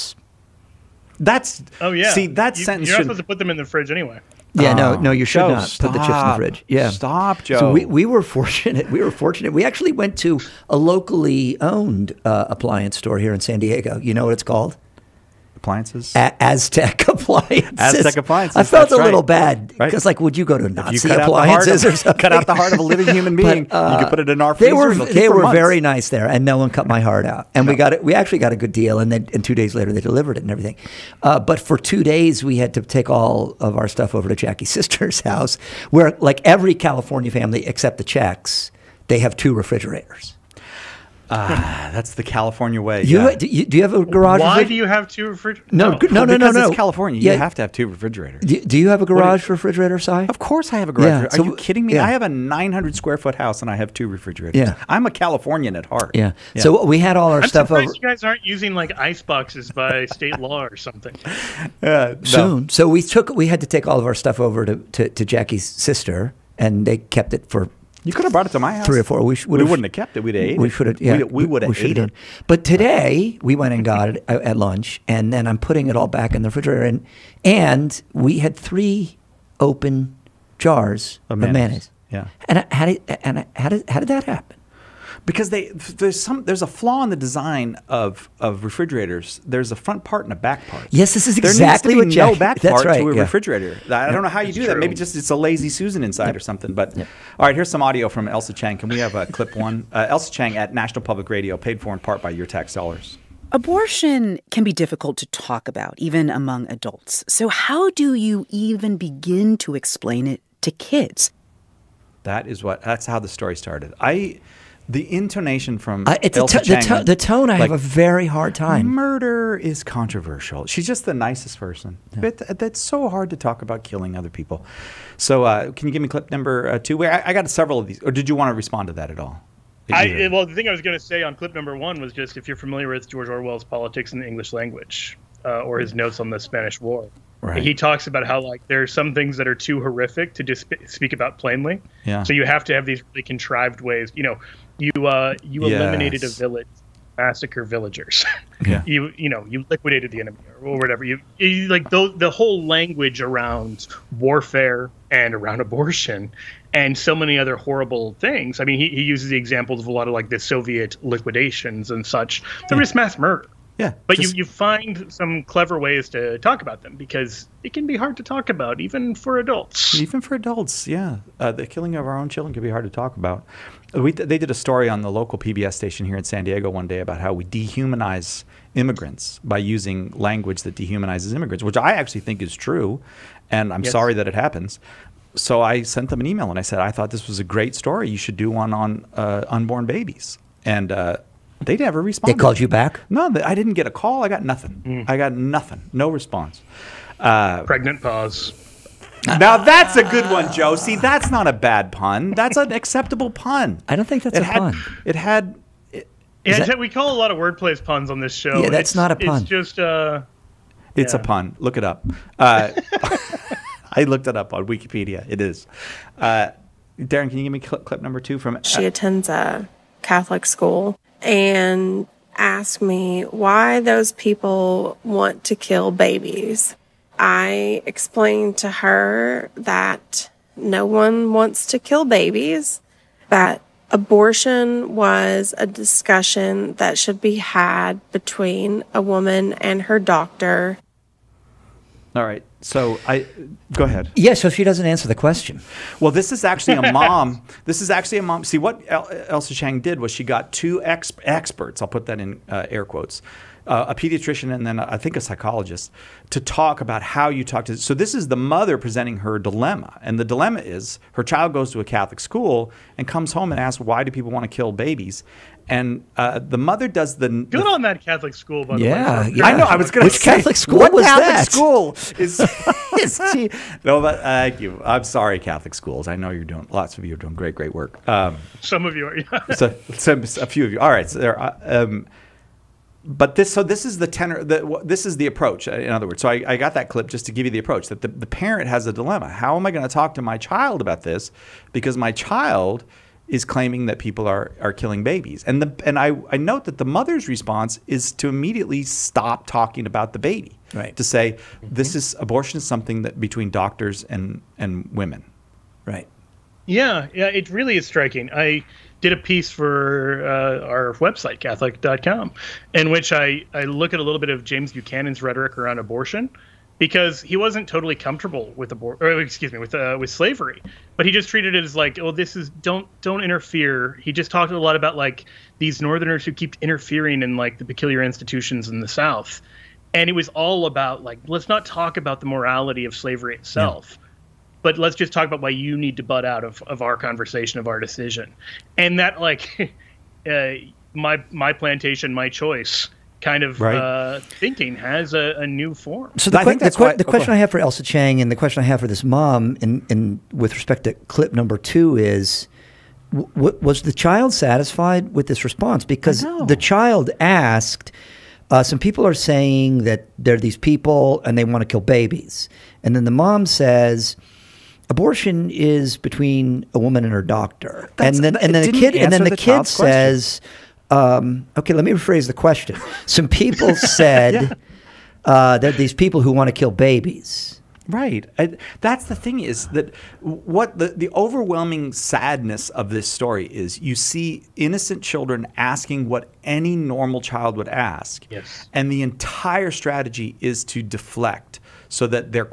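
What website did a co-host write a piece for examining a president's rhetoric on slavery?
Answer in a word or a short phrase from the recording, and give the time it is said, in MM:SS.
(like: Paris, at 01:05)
catholic.com, at 05:11.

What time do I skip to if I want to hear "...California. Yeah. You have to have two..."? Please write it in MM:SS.
00:46.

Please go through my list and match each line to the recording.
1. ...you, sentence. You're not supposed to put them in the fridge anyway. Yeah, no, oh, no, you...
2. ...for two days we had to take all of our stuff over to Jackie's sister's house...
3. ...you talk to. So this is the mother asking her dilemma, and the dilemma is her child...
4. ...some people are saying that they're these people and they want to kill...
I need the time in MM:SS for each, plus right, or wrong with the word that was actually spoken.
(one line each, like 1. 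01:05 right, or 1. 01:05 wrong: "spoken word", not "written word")
1. 00:02 right
2. 00:31 right
3. 04:17 wrong: "presenting", not "asking"
4. 05:58 right.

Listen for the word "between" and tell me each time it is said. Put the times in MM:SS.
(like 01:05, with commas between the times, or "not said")
03:58, 05:03, 06:05.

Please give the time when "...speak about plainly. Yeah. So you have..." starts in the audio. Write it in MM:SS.
02:20.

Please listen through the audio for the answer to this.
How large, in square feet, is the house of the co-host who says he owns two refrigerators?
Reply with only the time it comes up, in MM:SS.
00:52.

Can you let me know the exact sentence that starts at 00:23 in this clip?
but, uh, you could uh, put it in our freezer.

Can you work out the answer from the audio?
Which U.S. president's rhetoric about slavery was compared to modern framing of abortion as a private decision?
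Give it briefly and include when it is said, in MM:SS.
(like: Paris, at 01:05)
James Buchanan, at 05:14.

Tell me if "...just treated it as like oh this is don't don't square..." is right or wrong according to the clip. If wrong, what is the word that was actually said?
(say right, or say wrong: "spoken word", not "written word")
wrong: "interfere", not "square".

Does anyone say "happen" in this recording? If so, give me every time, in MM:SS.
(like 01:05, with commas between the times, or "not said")
01:24, 03:04.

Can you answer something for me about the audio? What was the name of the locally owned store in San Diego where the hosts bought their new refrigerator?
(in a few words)
Aztec Appliances.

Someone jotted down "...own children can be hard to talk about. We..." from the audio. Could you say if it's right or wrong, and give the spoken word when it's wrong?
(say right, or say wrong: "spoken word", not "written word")
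right.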